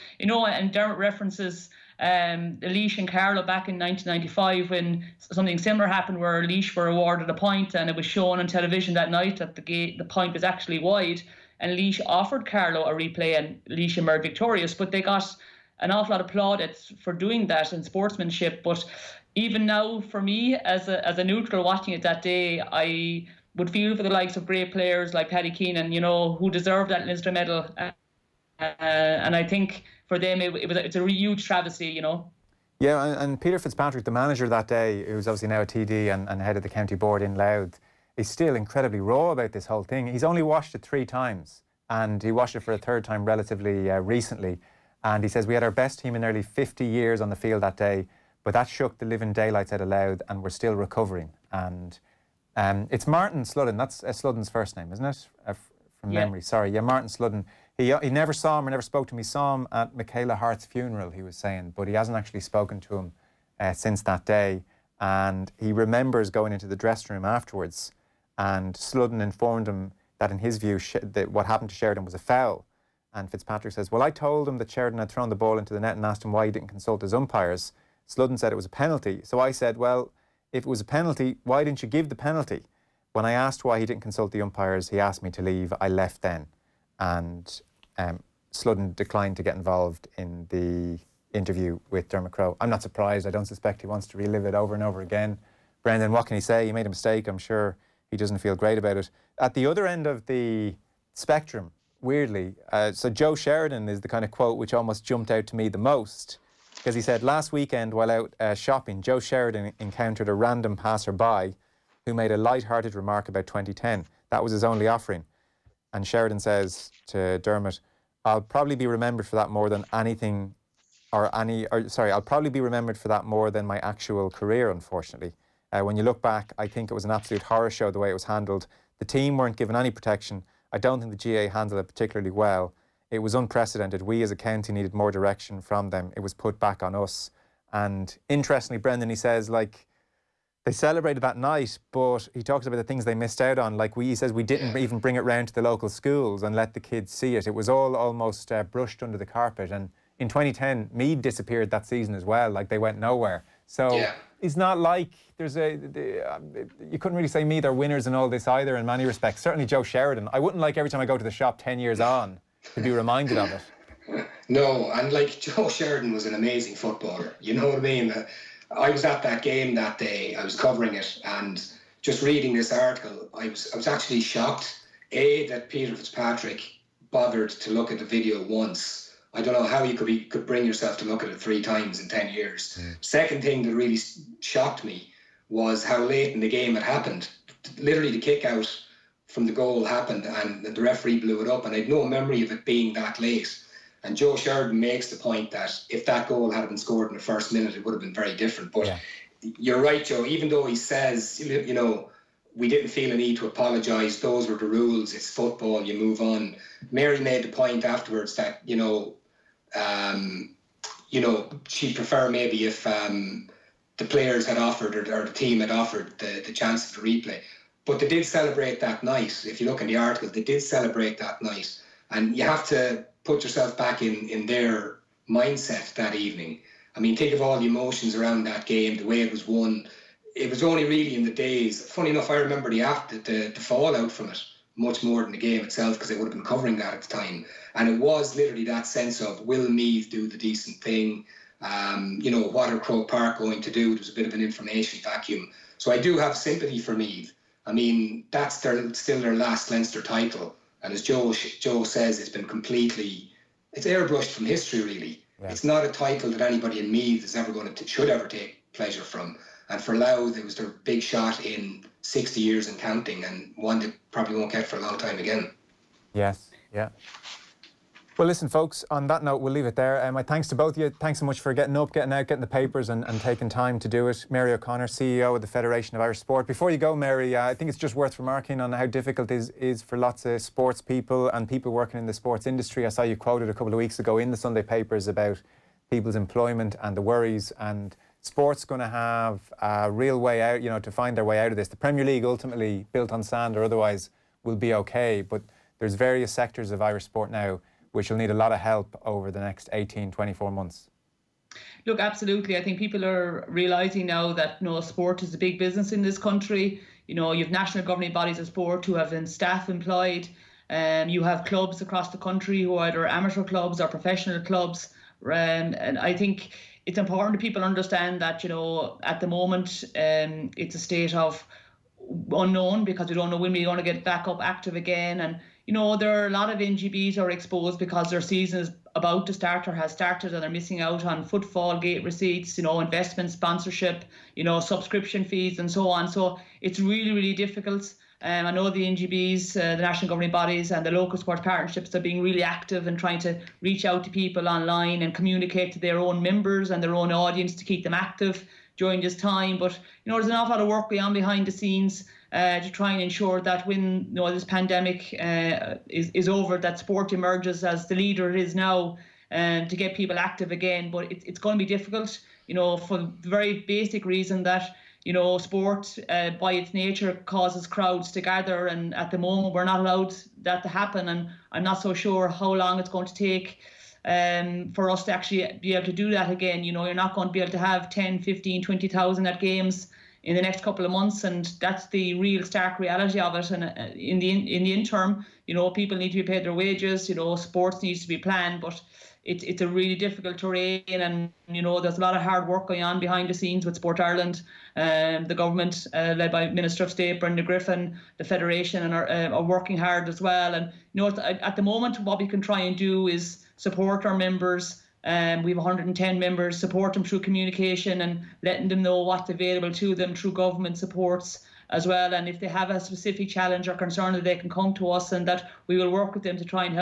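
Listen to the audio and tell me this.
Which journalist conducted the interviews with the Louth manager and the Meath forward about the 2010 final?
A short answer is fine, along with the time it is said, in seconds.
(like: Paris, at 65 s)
Dermot Crowe, at 92 s.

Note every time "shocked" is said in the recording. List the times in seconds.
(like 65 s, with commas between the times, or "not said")
174 s, 184 s.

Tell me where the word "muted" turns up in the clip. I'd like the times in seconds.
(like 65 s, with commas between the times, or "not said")
not said.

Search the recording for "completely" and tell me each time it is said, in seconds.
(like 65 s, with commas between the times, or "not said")
252 s.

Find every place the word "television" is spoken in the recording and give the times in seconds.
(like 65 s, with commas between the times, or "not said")
8 s.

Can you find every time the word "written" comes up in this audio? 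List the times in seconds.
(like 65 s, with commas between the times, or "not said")
not said.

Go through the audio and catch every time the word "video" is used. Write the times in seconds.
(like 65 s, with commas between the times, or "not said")
178 s.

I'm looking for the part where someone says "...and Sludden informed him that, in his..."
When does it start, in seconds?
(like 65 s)
68 s.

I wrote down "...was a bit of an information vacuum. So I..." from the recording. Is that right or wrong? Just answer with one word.
right.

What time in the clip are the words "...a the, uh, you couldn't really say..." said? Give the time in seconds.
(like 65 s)
155 s.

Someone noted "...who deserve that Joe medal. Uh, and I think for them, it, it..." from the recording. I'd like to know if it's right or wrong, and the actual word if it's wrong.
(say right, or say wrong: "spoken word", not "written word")
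wrong: "Leinster", not "Joe".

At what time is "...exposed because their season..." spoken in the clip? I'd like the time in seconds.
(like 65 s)
327 s.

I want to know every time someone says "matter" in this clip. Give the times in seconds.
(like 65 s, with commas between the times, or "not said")
not said.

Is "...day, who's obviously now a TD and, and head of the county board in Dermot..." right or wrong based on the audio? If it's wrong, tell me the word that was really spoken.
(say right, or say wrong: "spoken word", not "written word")
wrong: "Louth", not "Dermot".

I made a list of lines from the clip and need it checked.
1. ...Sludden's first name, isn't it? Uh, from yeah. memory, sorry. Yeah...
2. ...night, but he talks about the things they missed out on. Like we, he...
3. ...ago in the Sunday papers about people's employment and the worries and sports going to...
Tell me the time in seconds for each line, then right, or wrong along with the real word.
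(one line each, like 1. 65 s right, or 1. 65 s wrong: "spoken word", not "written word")
1. 54 s right
2. 141 s right
3. 283 s right.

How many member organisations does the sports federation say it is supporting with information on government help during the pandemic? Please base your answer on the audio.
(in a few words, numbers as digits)
110.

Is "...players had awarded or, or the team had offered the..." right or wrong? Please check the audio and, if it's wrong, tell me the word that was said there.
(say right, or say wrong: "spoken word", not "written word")
wrong: "offered", not "awarded".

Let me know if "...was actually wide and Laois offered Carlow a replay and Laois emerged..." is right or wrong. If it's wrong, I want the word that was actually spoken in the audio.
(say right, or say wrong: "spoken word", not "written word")
right.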